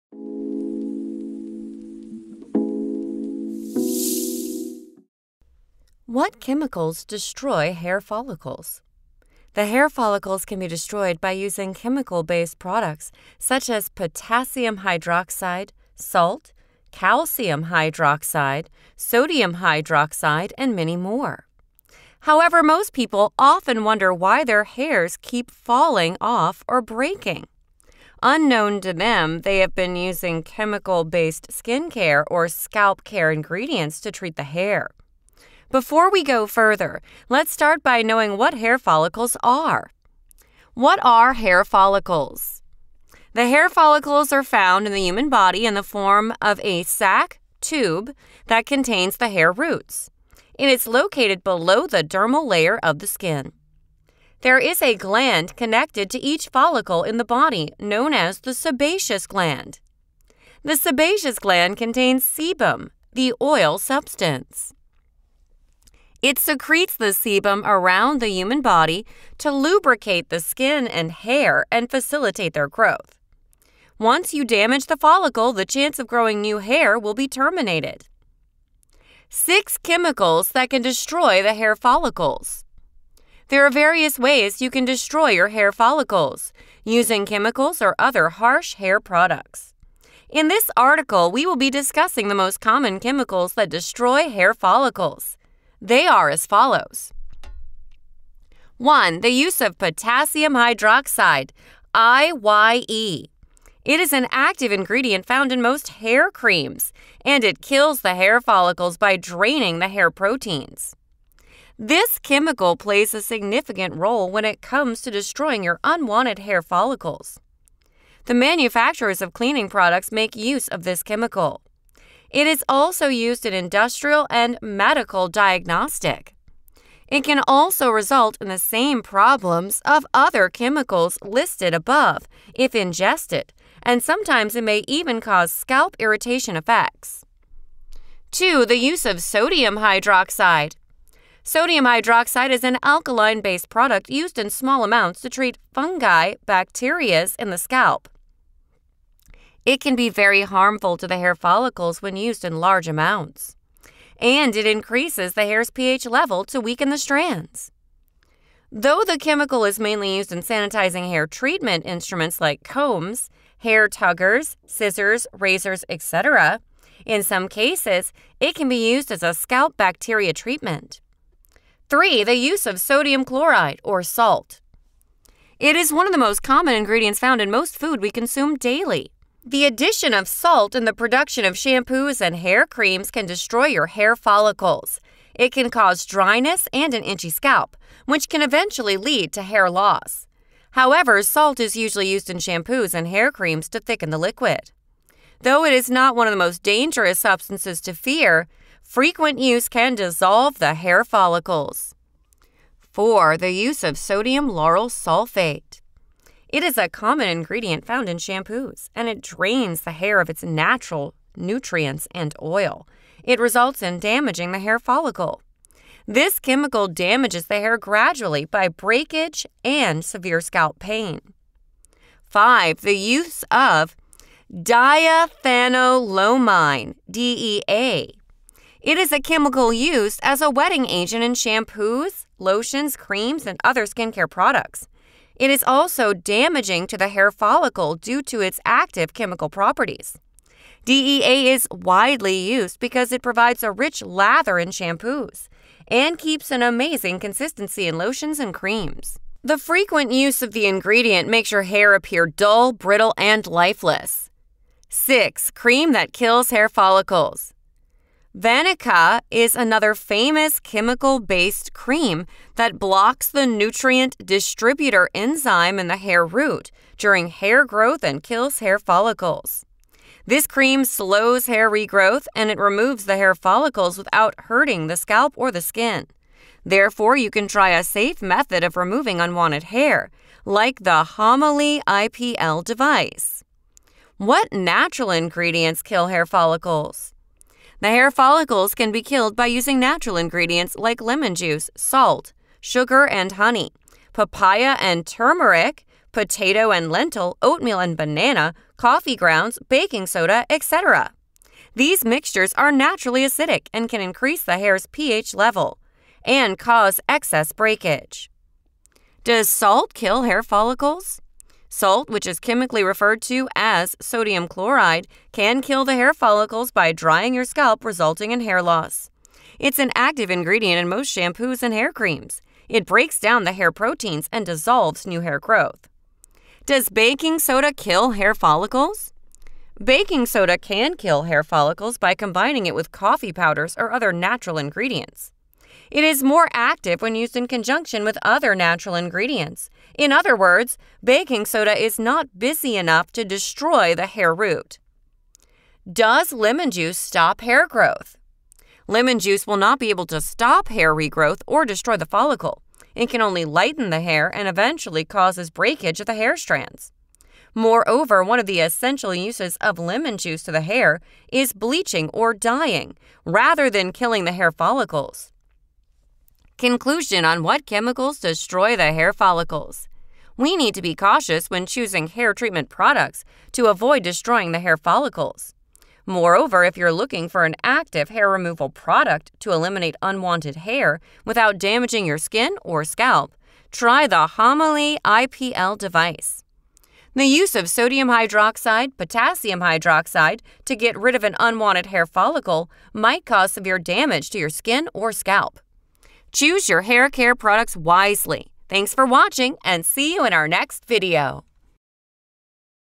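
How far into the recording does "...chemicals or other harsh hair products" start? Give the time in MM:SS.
01:27.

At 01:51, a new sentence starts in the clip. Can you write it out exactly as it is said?
This chemical plays a significant role when it comes to destroying your unwanted hair follicles.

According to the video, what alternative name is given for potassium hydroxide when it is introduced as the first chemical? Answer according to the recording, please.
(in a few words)
lye.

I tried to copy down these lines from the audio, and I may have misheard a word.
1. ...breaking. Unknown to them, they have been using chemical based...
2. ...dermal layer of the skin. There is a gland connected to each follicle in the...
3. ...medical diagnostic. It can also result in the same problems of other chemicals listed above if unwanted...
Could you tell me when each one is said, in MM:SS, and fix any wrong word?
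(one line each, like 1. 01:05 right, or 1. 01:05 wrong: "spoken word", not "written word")
1. 00:26 right
2. 00:52 right
3. 02:04 wrong: "ingested", not "unwanted".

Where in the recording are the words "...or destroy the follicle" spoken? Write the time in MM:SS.
05:51.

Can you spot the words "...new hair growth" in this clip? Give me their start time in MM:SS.
05:25.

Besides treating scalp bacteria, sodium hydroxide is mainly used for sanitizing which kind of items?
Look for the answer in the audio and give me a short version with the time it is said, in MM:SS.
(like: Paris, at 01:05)
hair treatment instruments, at 02:41.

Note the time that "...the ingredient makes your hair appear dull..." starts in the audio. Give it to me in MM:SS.
04:10.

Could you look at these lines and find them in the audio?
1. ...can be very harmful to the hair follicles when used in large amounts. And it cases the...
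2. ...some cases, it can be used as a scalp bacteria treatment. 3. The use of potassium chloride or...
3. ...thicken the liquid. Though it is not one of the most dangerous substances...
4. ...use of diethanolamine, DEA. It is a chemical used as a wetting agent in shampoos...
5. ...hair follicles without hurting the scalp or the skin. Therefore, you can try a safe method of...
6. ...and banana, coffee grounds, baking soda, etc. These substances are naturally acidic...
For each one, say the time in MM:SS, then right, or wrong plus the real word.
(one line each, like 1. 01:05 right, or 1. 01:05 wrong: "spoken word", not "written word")
1. 02:29 wrong: "increases", not "cases"
2. 02:47 wrong: "sodium", not "potassium"
3. 03:13 right
4. 03:42 right
5. 04:33 right
6. 04:57 wrong: "mixtures", not "substances".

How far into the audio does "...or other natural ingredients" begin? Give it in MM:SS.
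05:33.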